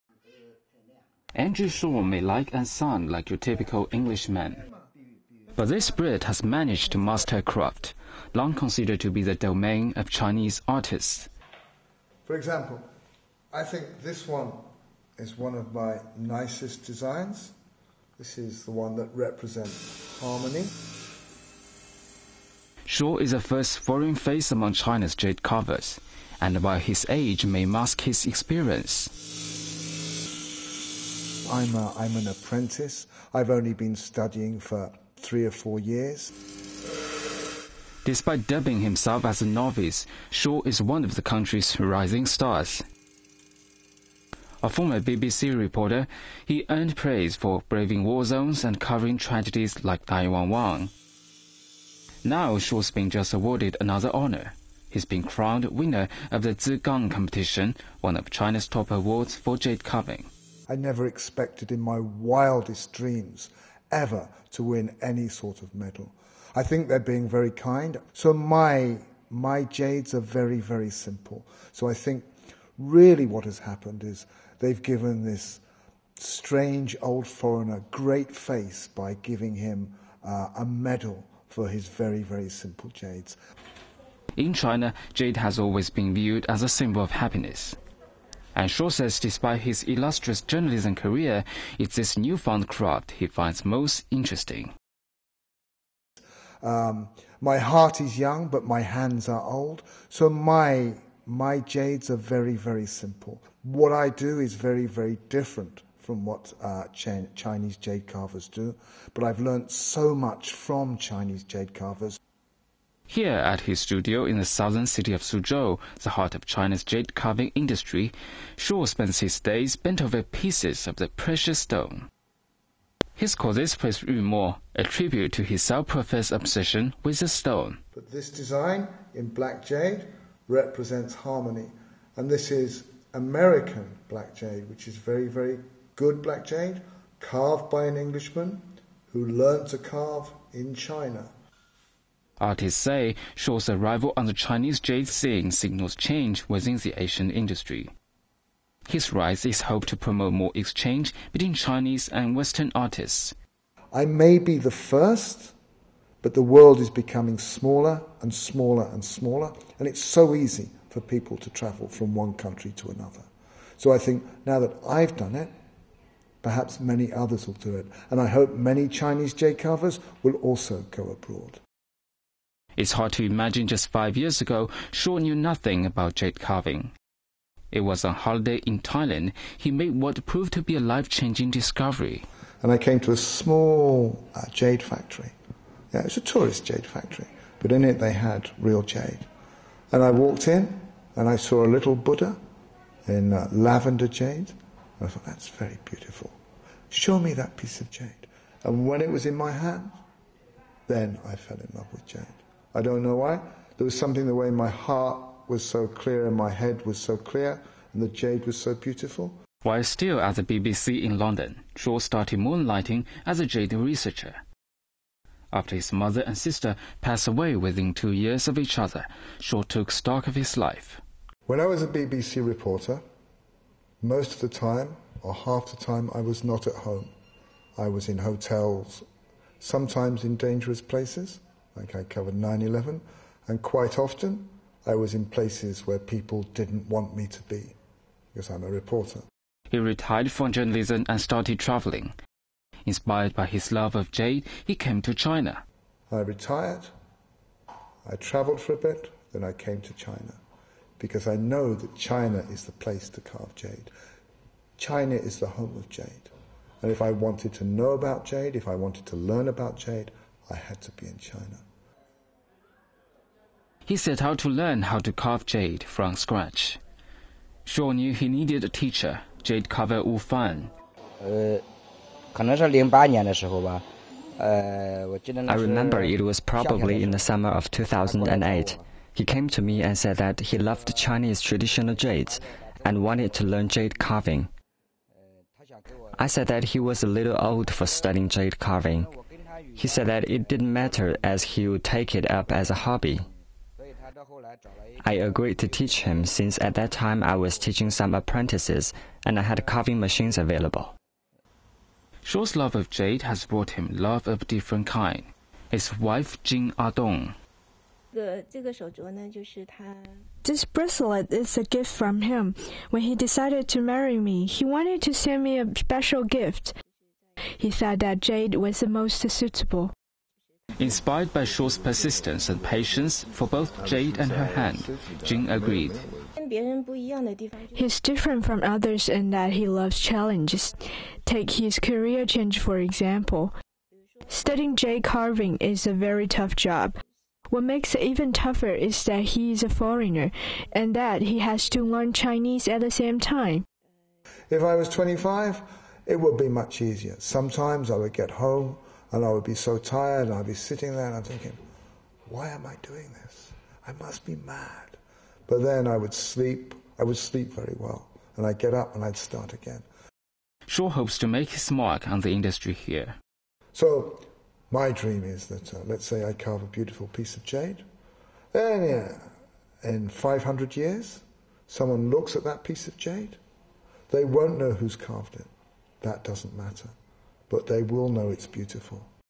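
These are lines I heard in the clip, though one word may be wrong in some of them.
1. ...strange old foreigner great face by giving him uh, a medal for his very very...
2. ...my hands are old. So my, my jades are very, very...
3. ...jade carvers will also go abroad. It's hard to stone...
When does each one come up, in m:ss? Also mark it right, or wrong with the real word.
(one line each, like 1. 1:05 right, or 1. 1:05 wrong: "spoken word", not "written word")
1. 1:16 right
2. 1:38 right
3. 2:49 wrong: "imagine", not "stone".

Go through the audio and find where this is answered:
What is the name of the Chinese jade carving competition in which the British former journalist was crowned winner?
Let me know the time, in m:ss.
0:56.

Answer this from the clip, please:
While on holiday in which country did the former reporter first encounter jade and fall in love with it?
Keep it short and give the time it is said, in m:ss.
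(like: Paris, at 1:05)
Thailand, at 2:58.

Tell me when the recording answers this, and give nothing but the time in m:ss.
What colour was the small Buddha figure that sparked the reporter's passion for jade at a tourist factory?
3:13.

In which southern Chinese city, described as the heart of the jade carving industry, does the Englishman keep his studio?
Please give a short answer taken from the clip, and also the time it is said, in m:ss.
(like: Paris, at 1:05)
Suzhou, at 1:55.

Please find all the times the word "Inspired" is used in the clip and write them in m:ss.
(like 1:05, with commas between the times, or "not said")
4:02, 5:20.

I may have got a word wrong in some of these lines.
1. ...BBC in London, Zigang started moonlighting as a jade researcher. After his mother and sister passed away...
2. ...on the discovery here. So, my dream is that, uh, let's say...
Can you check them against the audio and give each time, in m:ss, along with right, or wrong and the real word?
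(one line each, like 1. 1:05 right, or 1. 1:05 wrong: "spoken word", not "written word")
1. 3:30 wrong: "Shaw", not "Zigang"
2. 6:02 wrong: "industry", not "discovery".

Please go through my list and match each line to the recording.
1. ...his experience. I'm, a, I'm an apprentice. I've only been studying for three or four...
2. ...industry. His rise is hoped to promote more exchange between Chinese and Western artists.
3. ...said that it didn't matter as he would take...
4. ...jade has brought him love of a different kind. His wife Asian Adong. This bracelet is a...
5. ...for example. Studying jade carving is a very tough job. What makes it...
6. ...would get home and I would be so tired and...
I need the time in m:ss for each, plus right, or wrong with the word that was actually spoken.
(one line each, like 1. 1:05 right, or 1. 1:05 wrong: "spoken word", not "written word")
1. 0:28 right
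2. 2:27 right
3. 4:49 right
4. 5:02 wrong: "Jing", not "Asian"
5. 5:32 right
6. 5:47 right.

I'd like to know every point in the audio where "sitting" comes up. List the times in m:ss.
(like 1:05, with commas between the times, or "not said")
5:50.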